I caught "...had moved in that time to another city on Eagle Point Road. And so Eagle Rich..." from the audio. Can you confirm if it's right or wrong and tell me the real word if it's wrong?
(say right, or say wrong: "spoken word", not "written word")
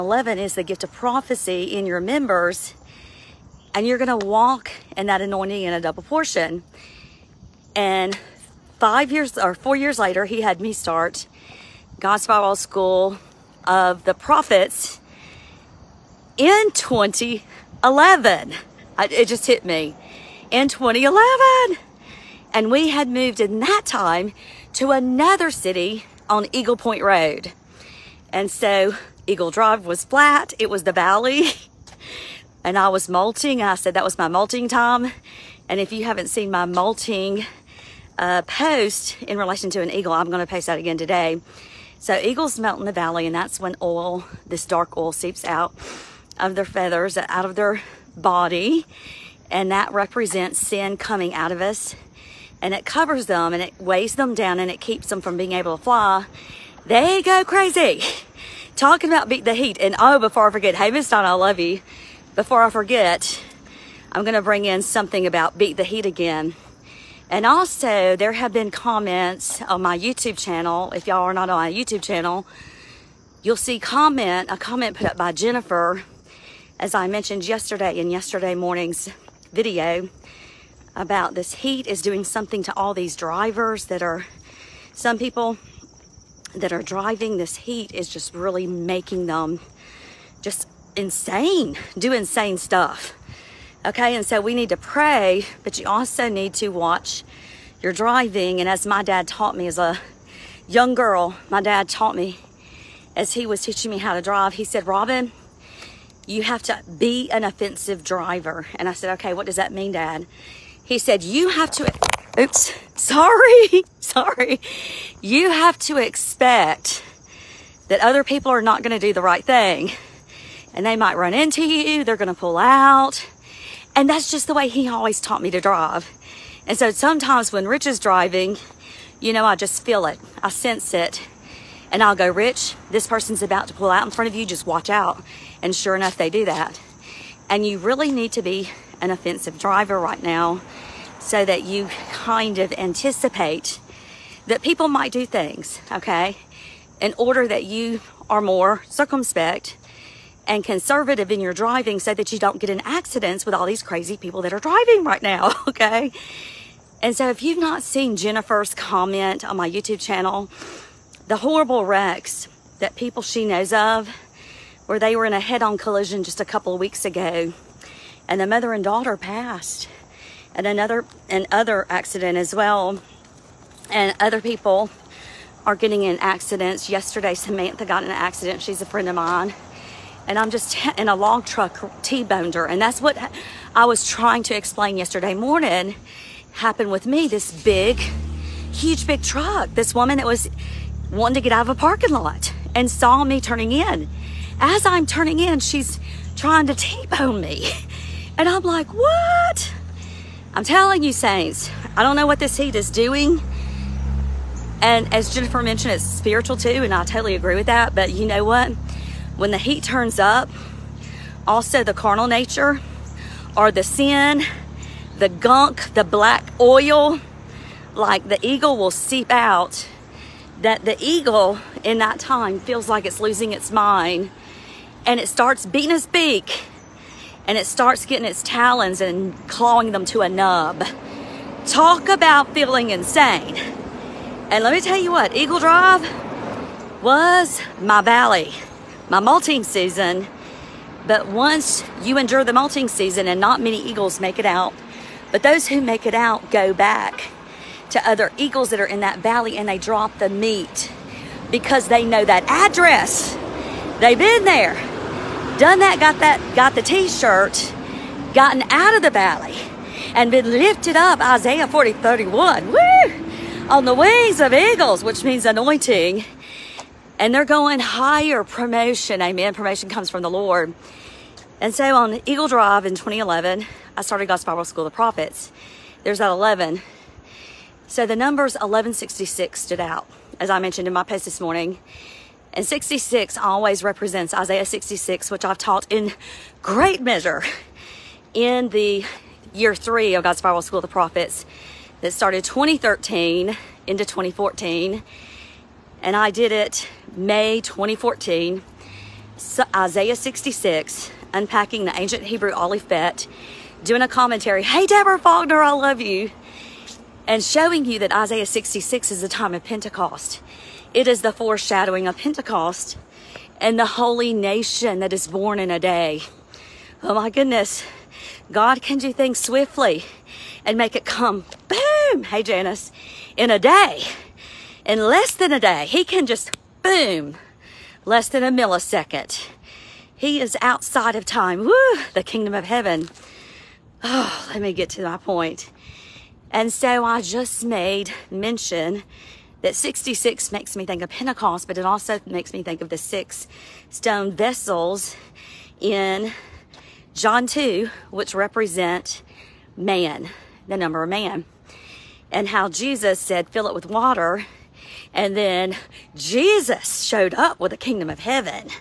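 wrong: "Drive", not "Rich".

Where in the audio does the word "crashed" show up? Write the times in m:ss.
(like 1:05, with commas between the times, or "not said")
not said.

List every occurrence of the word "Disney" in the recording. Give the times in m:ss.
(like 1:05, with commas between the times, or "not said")
not said.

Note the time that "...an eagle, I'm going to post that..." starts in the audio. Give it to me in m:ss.
0:39.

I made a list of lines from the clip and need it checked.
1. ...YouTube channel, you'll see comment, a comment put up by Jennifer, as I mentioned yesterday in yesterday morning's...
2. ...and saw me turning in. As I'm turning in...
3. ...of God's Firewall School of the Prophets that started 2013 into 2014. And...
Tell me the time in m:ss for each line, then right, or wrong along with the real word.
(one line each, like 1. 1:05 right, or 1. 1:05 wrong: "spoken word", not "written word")
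1. 1:11 right
2. 3:12 right
3. 4:50 right.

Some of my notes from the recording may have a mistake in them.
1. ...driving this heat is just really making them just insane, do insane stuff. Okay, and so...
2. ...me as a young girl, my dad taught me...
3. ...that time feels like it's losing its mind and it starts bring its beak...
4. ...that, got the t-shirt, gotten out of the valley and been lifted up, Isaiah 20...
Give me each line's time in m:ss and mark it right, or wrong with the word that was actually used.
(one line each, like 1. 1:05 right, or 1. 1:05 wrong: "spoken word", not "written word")
1. 1:26 right
2. 1:39 right
3. 3:41 wrong: "beating", not "bring"
4. 4:16 wrong: "40", not "20".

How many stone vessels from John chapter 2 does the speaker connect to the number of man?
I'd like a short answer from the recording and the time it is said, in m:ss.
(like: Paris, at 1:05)
6, at 5:42.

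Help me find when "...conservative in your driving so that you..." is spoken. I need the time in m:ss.
2:30.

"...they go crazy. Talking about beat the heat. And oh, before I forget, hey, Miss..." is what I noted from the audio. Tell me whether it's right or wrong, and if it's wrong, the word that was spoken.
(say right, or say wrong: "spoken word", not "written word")
right.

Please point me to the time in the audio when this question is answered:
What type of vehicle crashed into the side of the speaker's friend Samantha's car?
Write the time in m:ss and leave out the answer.
3:01.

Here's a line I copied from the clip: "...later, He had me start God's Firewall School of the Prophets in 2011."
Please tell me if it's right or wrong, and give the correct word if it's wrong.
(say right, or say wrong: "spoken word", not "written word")
right.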